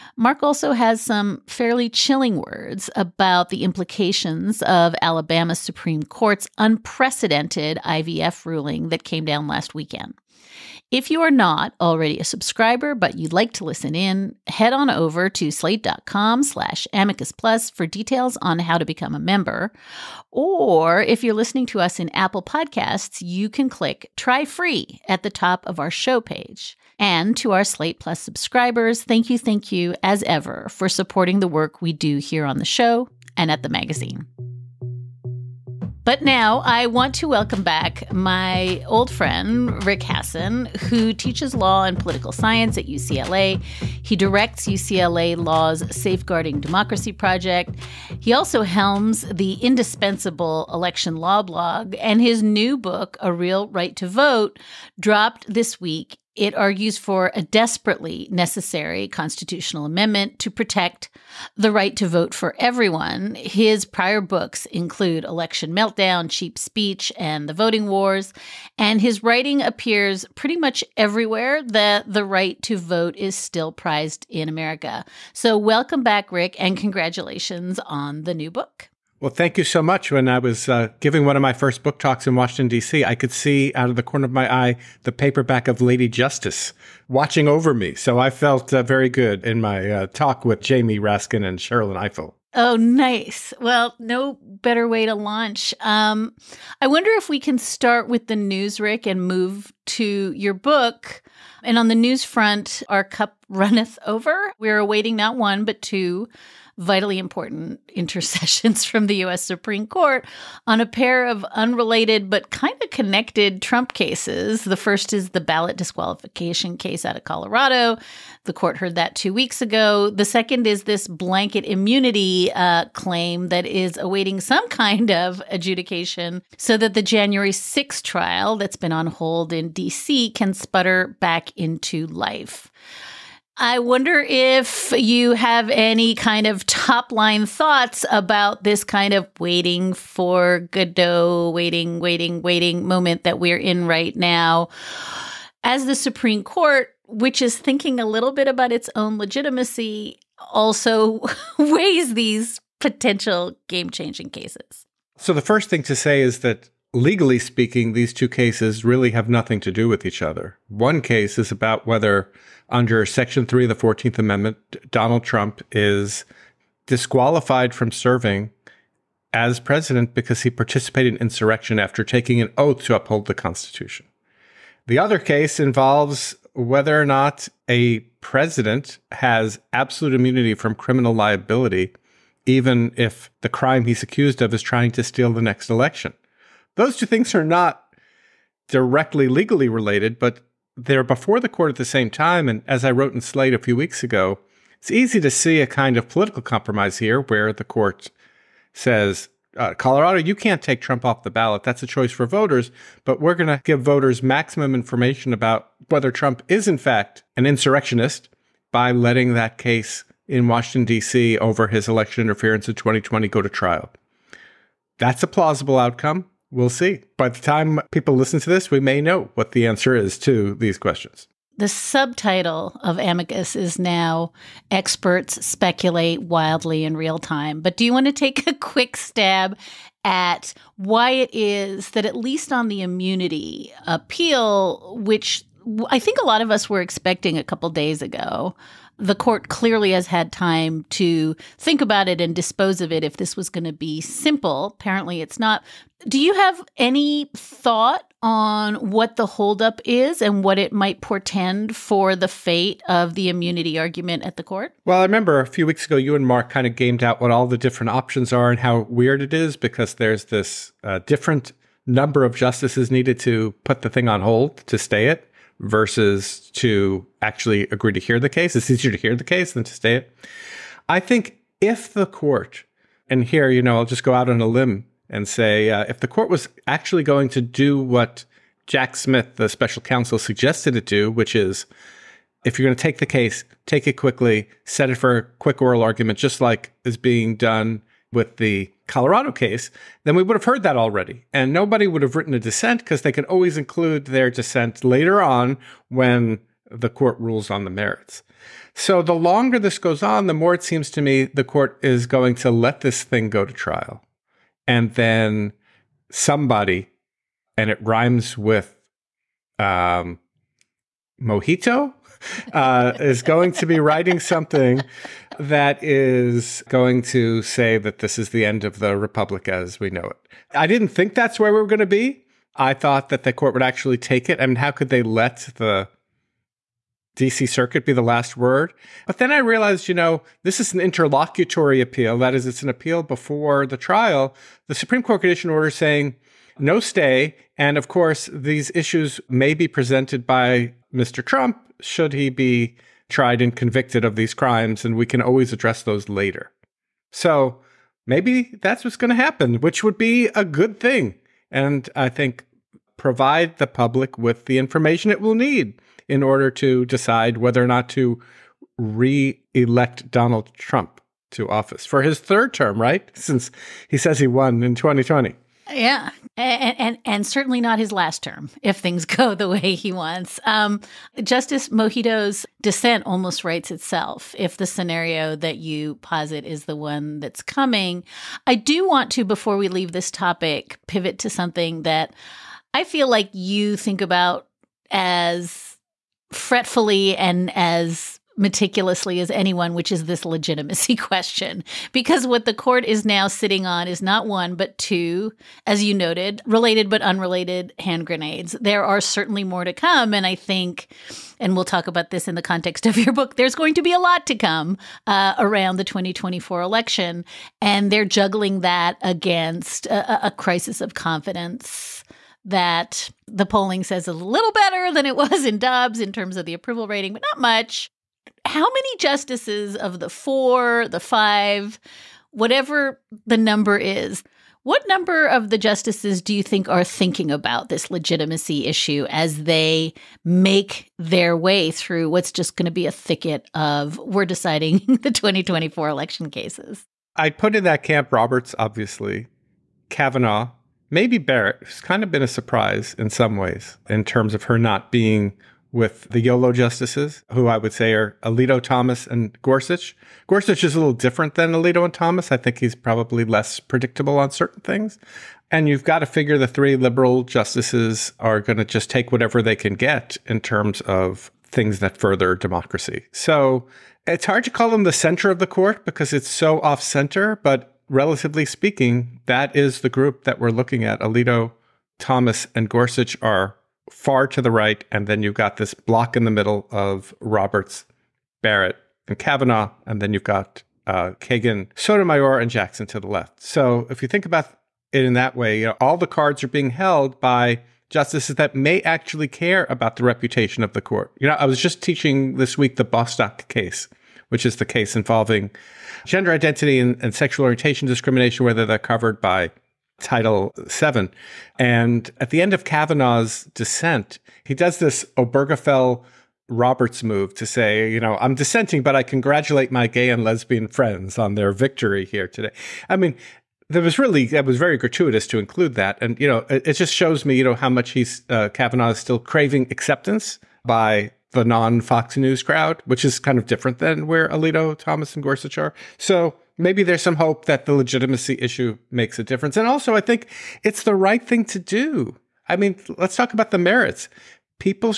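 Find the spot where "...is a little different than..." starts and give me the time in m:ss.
7:30.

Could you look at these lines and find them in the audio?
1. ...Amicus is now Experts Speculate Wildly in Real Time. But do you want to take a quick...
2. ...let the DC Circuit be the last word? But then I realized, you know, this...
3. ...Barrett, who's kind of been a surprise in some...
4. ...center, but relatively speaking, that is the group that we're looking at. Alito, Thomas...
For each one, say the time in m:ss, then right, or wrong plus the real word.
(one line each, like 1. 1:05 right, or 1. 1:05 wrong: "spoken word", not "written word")
1. 3:42 right
2. 5:25 right
3. 7:21 right
4. 7:46 right.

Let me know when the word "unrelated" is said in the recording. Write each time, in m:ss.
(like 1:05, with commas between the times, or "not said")
1:51, 6:37.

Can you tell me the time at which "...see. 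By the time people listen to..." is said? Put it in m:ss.
3:36.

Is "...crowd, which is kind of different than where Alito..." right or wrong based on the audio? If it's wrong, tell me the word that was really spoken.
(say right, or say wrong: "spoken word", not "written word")
right.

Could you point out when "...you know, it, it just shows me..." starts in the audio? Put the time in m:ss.
8:36.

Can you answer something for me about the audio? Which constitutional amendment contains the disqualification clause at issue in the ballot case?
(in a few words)
14th Amendment.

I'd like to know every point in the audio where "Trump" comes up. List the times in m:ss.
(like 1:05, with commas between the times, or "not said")
1:53, 2:45, 3:20, 3:26, 5:41, 6:00.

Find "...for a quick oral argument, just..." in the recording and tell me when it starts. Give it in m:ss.
4:44.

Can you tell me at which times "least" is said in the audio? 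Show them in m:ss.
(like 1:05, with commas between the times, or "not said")
3:52.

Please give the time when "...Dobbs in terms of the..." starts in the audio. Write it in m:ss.
6:55.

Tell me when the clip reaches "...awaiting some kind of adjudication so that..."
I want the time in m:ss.
2:03.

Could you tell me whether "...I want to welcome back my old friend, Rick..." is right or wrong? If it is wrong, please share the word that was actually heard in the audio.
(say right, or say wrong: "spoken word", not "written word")
right.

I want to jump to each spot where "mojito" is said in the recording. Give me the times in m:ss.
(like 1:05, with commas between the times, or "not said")
5:11, 6:11.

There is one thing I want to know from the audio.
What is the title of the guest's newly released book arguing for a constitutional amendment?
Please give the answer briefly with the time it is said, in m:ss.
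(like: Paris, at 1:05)
A Real Right to Vote, at 0:53.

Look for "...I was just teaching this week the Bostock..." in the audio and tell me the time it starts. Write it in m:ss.
8:11.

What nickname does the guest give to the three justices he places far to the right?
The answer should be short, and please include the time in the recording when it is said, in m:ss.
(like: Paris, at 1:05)
YOLO justices, at 7:26.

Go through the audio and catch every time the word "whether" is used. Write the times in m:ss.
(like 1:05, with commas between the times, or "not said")
2:41, 2:56, 3:25, 5:57, 8:18.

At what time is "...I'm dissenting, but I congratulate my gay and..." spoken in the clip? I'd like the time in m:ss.
8:28.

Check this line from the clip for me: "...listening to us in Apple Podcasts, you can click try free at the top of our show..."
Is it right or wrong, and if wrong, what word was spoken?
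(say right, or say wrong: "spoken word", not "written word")
right.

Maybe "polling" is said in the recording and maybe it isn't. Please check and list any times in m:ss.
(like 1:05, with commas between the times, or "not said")
6:53.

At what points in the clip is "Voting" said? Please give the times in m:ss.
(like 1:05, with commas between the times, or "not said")
1:07.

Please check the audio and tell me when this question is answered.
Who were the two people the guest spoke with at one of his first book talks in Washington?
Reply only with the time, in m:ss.
1:30.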